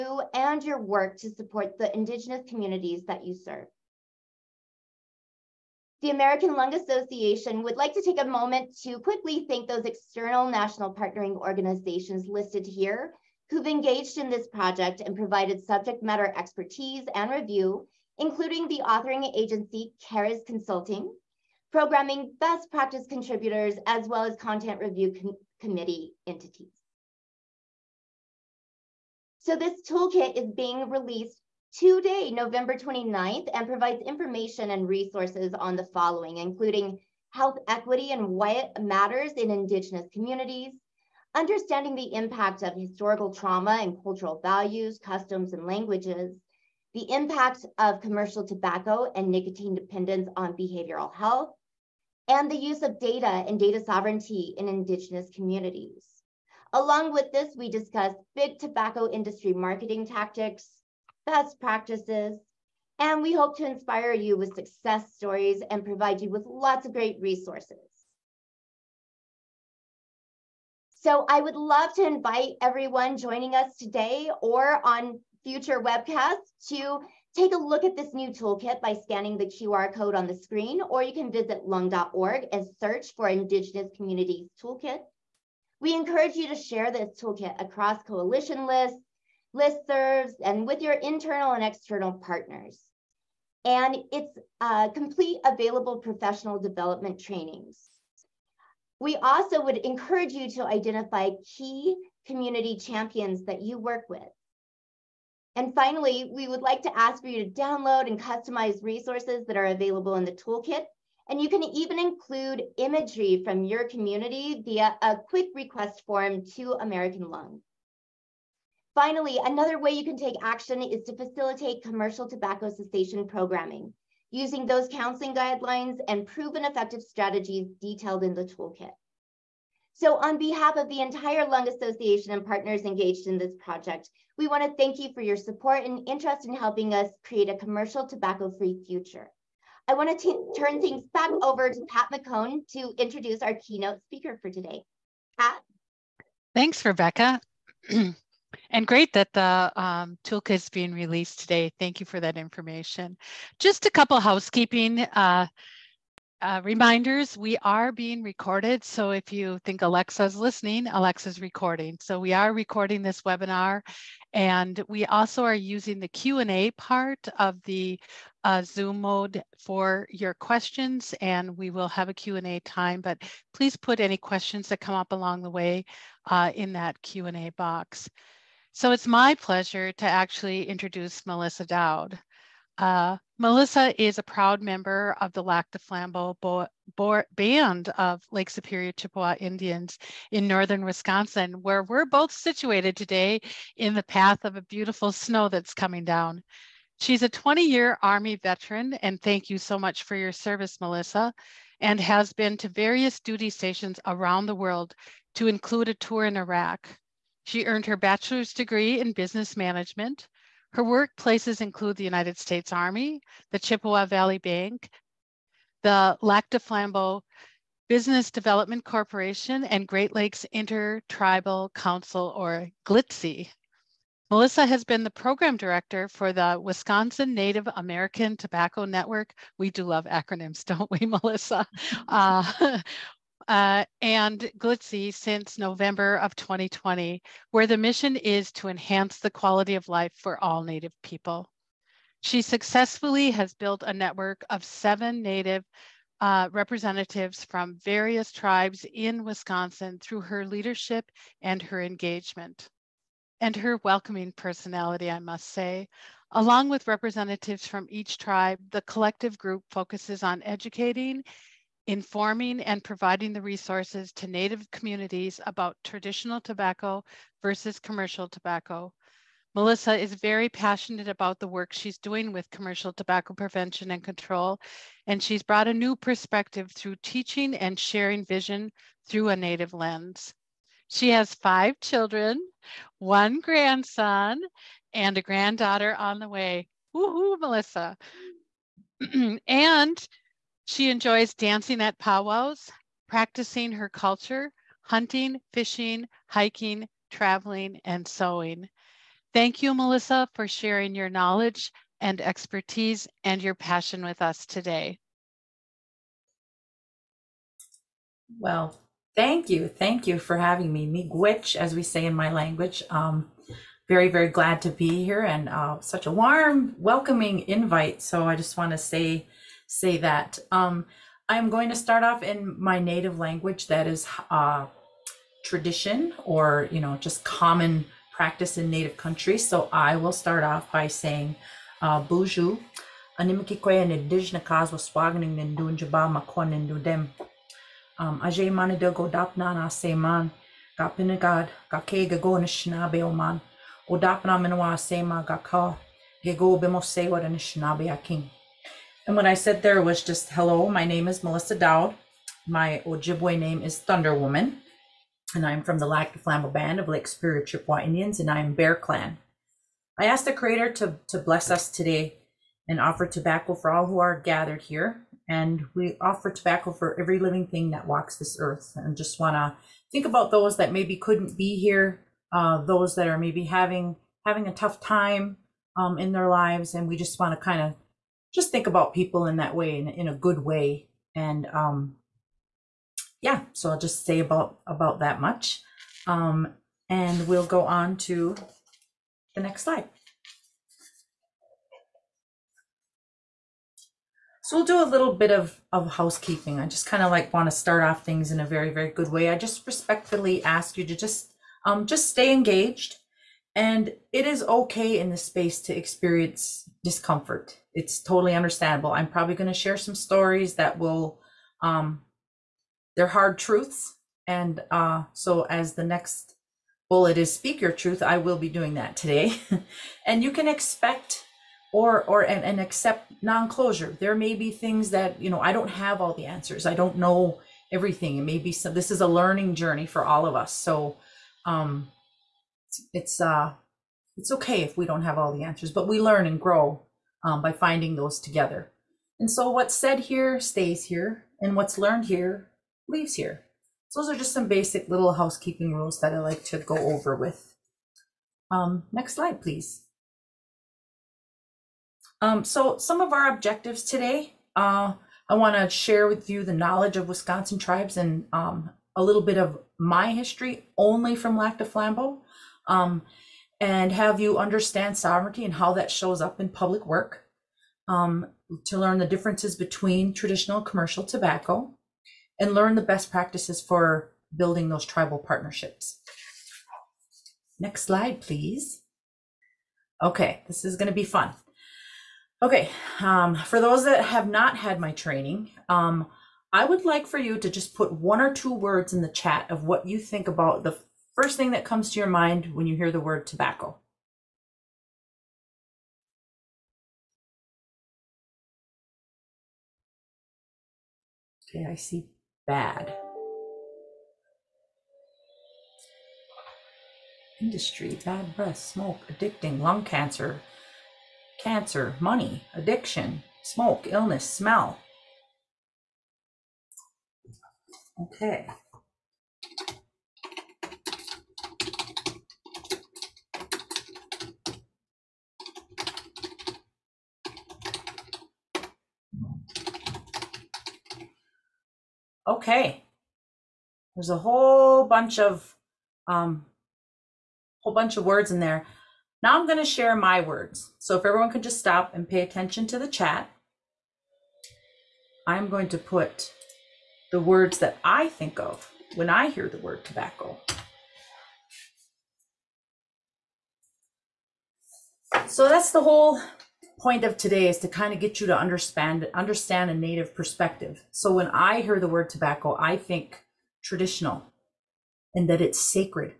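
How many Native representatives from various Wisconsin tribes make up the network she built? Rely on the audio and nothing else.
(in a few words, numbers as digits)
7.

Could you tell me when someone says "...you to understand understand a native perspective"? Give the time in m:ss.
9:18.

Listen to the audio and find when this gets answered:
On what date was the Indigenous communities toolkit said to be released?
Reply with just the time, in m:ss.
0:32.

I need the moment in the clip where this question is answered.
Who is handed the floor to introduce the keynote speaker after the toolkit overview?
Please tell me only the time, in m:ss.
2:21.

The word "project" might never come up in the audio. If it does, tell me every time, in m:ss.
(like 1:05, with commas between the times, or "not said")
0:14, 2:13.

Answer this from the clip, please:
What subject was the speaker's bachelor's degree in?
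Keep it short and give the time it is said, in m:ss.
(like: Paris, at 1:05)
Business management, at 3:29.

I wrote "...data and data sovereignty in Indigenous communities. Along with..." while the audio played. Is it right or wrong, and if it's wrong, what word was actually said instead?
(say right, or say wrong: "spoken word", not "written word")
right.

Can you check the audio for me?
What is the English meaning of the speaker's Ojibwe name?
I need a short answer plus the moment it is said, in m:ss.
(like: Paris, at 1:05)
Thunder Woman, at 5:53.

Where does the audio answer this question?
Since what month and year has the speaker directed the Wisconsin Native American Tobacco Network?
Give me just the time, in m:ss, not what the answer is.
3:55.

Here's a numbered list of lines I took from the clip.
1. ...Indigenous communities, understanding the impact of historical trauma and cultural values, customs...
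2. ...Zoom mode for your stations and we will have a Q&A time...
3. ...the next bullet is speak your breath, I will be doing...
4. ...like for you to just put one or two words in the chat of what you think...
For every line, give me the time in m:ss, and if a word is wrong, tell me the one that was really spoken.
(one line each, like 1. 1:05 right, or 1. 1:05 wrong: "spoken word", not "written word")
1. 0:39 right
2. 2:48 wrong: "questions", not "stations"
3. 6:55 wrong: "truth", not "breath"
4. 8:06 right.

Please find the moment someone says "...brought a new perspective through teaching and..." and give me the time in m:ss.
4:35.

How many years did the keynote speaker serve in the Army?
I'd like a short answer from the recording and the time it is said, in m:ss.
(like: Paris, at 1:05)
20, at 3:17.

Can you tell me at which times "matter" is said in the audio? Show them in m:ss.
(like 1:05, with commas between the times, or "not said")
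0:16, 0:38.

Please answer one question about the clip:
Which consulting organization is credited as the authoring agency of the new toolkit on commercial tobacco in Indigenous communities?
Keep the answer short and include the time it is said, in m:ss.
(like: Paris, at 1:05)
CARES Consulting, at 0:20.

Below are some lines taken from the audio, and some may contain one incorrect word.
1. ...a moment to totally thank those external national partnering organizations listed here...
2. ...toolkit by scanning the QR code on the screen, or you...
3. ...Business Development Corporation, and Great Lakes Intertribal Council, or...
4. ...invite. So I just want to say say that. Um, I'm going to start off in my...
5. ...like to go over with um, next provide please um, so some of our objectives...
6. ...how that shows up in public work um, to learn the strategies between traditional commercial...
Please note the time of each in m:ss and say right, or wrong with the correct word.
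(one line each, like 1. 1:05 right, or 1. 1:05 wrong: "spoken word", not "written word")
1. 0:08 wrong: "quickly", not "totally"
2. 1:18 right
3. 3:37 right
4. 5:17 right
5. 7:26 wrong: "slide", not "provide"
6. 7:45 wrong: "differences", not "strategies".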